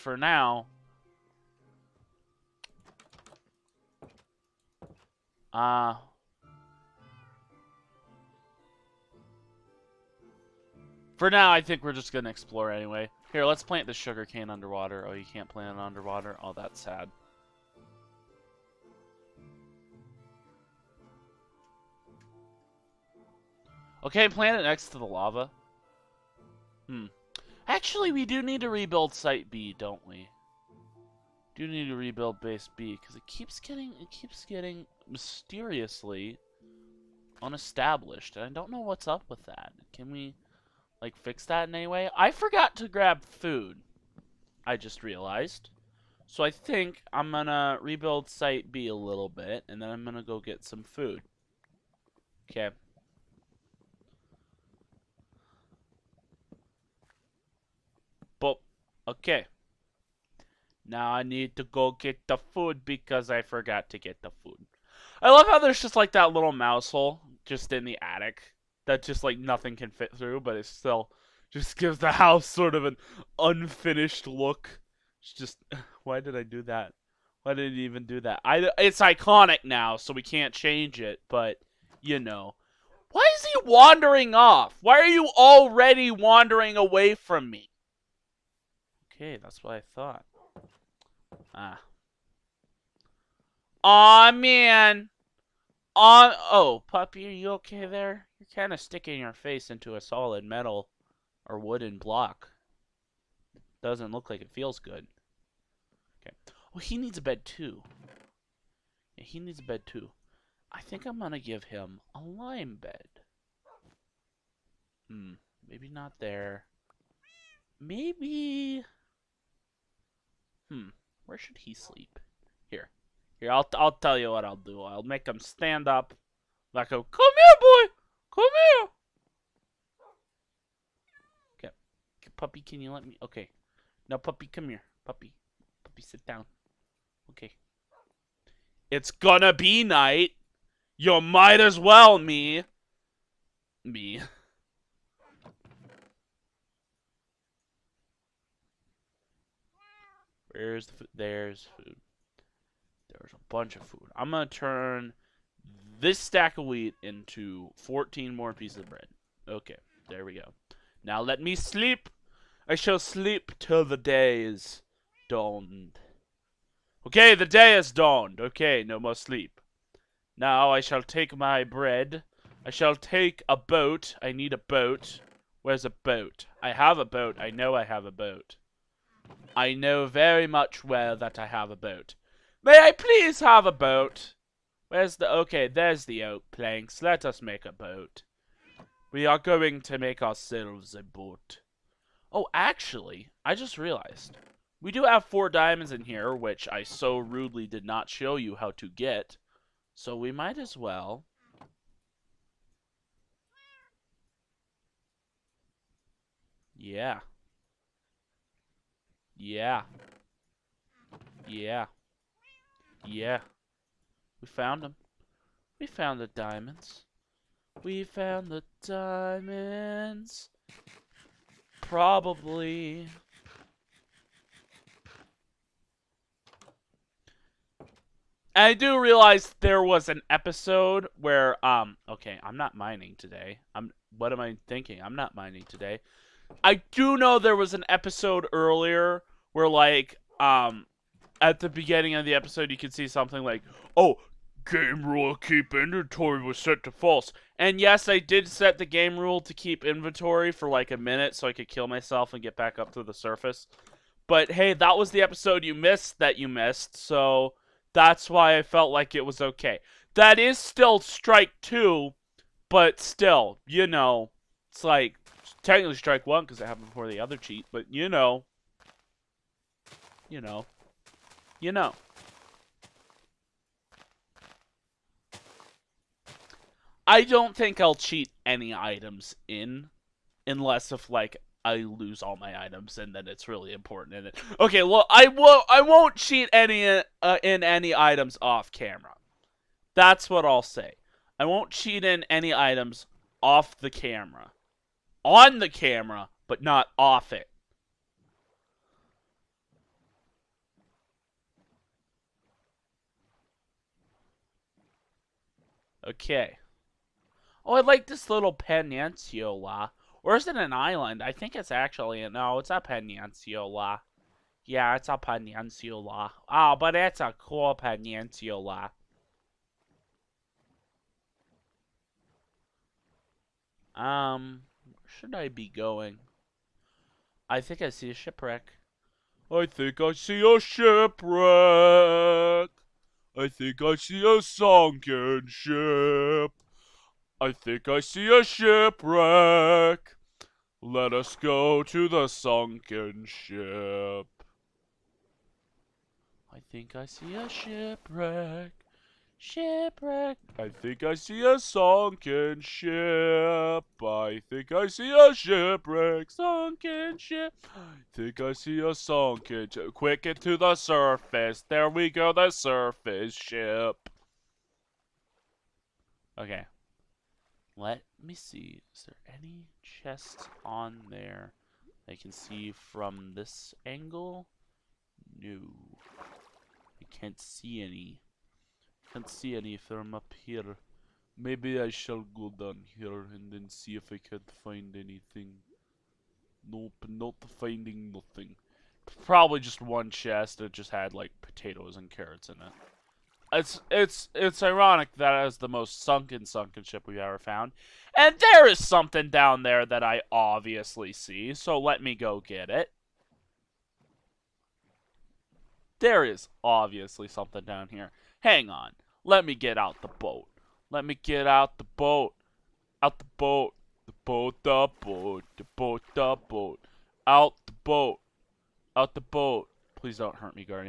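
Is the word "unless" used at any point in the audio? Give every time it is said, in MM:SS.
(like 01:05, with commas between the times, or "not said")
04:40.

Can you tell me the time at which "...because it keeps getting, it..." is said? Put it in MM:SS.
00:33.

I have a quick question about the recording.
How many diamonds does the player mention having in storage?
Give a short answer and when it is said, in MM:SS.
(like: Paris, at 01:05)
4, at 03:15.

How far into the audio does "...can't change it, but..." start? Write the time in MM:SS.
01:20.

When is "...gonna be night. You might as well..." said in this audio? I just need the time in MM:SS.
02:19.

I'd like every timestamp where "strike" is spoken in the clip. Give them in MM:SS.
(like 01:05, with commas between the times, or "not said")
04:20, 04:25.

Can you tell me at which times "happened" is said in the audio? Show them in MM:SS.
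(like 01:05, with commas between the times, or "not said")
04:26.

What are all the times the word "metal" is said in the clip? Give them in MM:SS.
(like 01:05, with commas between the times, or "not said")
01:40.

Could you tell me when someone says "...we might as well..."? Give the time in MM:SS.
03:20.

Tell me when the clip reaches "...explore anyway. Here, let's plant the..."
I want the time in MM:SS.
00:12.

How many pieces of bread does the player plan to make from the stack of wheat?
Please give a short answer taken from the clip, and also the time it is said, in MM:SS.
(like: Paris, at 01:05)
14, at 02:37.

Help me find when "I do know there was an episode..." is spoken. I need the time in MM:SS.
03:56.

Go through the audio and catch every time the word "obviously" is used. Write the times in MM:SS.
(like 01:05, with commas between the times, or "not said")
06:40, 06:46.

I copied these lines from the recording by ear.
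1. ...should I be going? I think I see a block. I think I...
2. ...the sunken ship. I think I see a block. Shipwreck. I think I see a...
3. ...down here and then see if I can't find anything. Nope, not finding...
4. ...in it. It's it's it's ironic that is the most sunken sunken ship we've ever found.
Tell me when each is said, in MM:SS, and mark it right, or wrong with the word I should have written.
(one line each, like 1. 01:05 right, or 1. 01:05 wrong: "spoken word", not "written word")
1. 05:25 wrong: "shipwreck", not "block"
2. 05:42 wrong: "shipwreck", not "block"
3. 06:22 right
4. 06:32 right.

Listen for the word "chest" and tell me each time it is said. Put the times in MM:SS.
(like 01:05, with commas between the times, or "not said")
06:09, 06:30.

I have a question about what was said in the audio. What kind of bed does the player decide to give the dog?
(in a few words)
Lime bed.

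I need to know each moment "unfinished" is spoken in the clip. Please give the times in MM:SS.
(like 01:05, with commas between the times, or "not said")
01:13.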